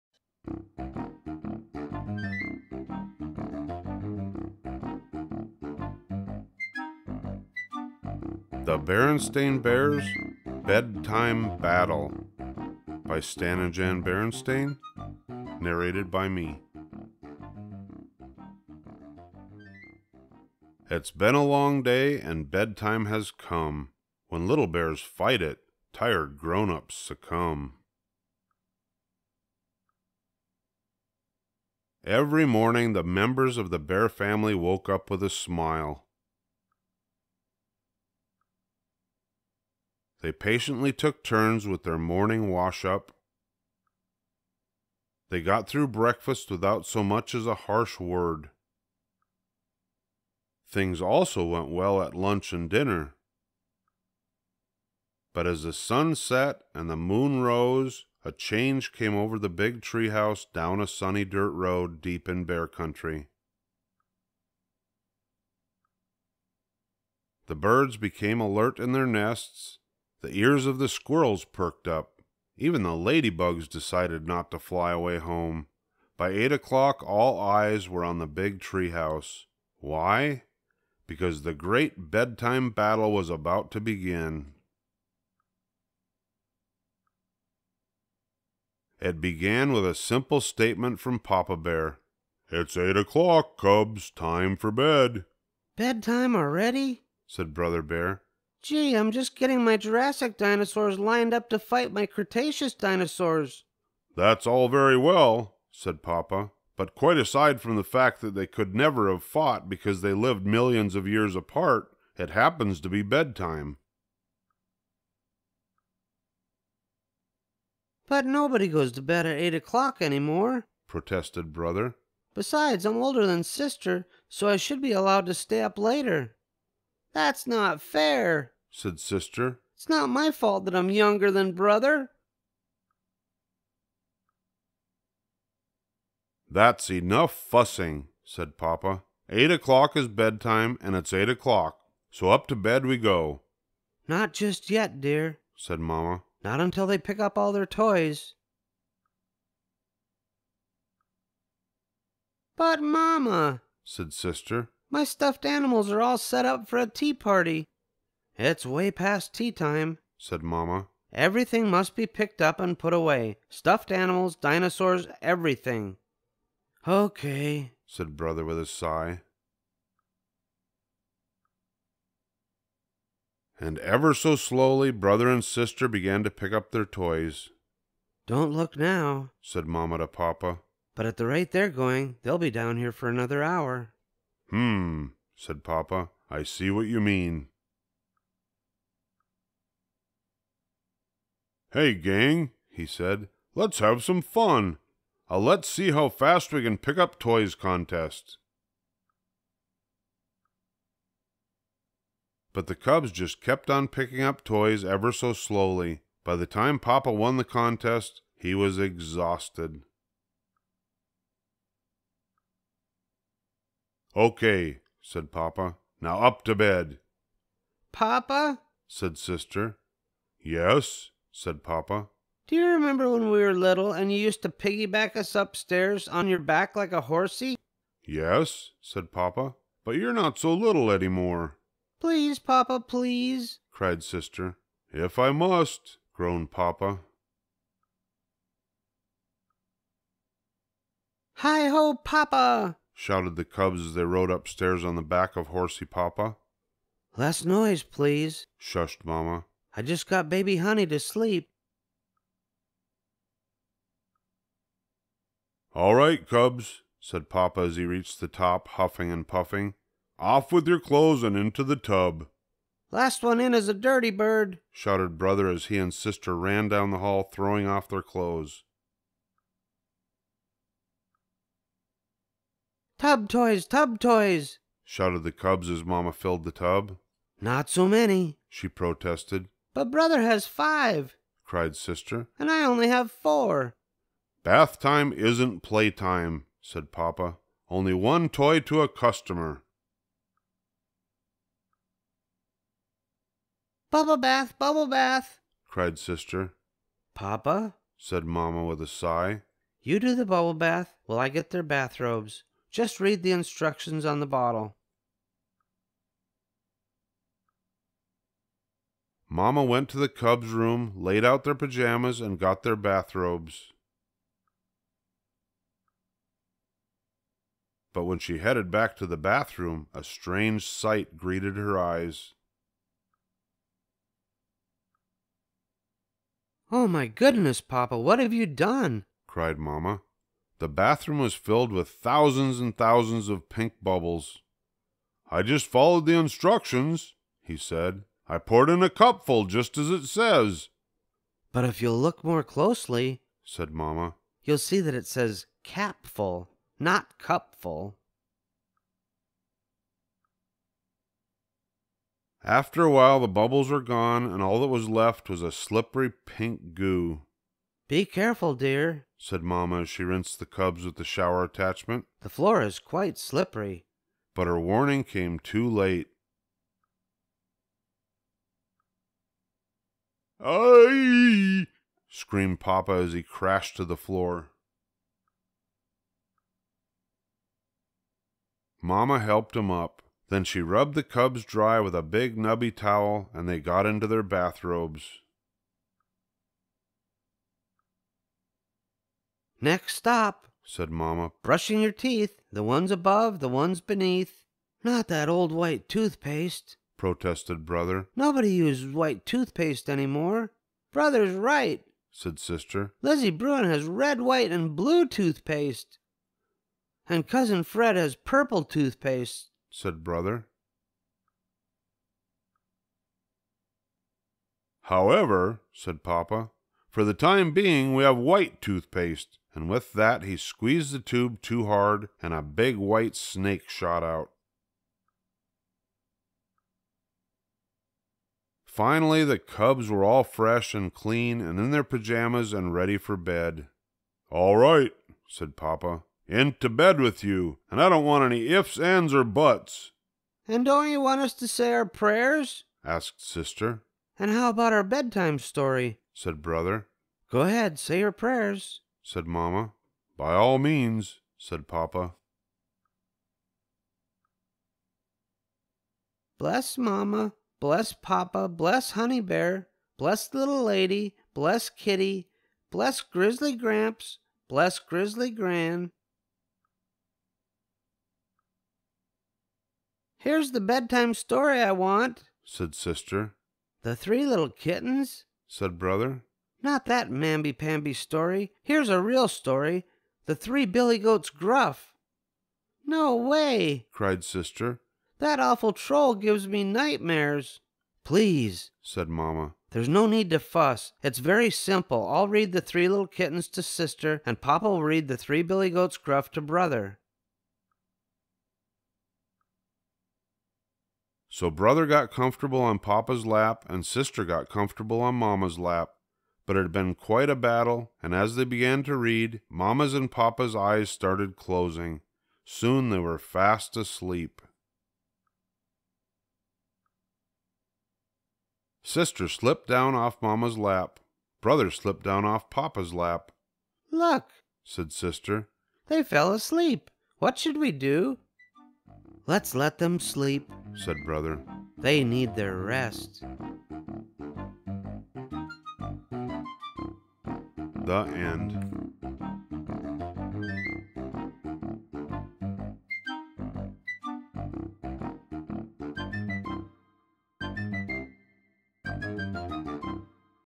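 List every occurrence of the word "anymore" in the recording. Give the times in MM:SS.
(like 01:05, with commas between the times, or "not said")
02:00, 06:39.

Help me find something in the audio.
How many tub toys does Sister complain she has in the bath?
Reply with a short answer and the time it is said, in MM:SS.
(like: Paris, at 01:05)
4, at 04:43.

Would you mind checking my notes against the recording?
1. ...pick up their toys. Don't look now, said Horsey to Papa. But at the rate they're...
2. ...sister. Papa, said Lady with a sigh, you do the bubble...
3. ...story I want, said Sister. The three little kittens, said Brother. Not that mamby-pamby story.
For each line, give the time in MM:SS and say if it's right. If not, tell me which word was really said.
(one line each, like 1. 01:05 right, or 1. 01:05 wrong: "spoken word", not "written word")
1. 02:56 wrong: "Mamma", not "Horsey"
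2. 04:55 wrong: "Mamma", not "Lady"
3. 07:51 right.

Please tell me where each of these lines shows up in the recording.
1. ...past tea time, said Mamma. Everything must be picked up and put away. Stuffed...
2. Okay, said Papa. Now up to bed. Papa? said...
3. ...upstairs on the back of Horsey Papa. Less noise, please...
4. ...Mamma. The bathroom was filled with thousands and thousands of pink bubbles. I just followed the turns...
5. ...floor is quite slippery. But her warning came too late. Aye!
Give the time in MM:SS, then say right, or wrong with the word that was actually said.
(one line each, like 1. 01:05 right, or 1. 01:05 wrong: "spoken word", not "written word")
1. 02:38 right
2. 03:34 right
3. 04:04 right
4. 05:29 wrong: "instructions", not "turns"
5. 06:02 right.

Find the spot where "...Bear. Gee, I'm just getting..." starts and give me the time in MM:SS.
01:37.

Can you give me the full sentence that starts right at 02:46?
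Okay, said Brother with a sigh.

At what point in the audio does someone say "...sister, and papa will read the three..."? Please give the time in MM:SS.
08:13.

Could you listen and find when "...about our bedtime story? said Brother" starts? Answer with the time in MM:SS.
07:24.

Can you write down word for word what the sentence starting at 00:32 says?
Every morning, the members of the bear family woke up with a smile.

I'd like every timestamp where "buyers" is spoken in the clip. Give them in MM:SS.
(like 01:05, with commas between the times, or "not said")
not said.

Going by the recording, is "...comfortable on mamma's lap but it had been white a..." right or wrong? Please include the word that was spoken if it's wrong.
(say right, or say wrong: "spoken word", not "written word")
wrong: "quite", not "white".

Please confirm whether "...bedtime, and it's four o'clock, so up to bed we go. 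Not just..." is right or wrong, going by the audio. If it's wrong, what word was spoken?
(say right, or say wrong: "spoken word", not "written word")
wrong: "eight", not "four".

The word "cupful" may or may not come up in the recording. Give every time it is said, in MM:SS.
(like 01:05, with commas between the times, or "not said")
05:38, 05:47.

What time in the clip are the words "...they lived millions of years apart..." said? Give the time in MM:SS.
01:50.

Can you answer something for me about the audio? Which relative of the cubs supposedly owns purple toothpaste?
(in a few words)
Cousin Fred.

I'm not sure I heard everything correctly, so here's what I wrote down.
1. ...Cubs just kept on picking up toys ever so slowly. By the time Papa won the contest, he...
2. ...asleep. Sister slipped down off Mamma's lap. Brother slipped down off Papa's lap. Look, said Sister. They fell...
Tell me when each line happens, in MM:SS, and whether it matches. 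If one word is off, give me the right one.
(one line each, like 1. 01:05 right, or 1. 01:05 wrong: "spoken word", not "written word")
1. 03:22 right
2. 08:33 right.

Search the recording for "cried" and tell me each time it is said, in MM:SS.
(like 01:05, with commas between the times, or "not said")
03:53, 04:41, 04:55, 05:29, 08:03.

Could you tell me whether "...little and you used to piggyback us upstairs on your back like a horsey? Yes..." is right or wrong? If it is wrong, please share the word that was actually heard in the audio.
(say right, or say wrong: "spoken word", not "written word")
right.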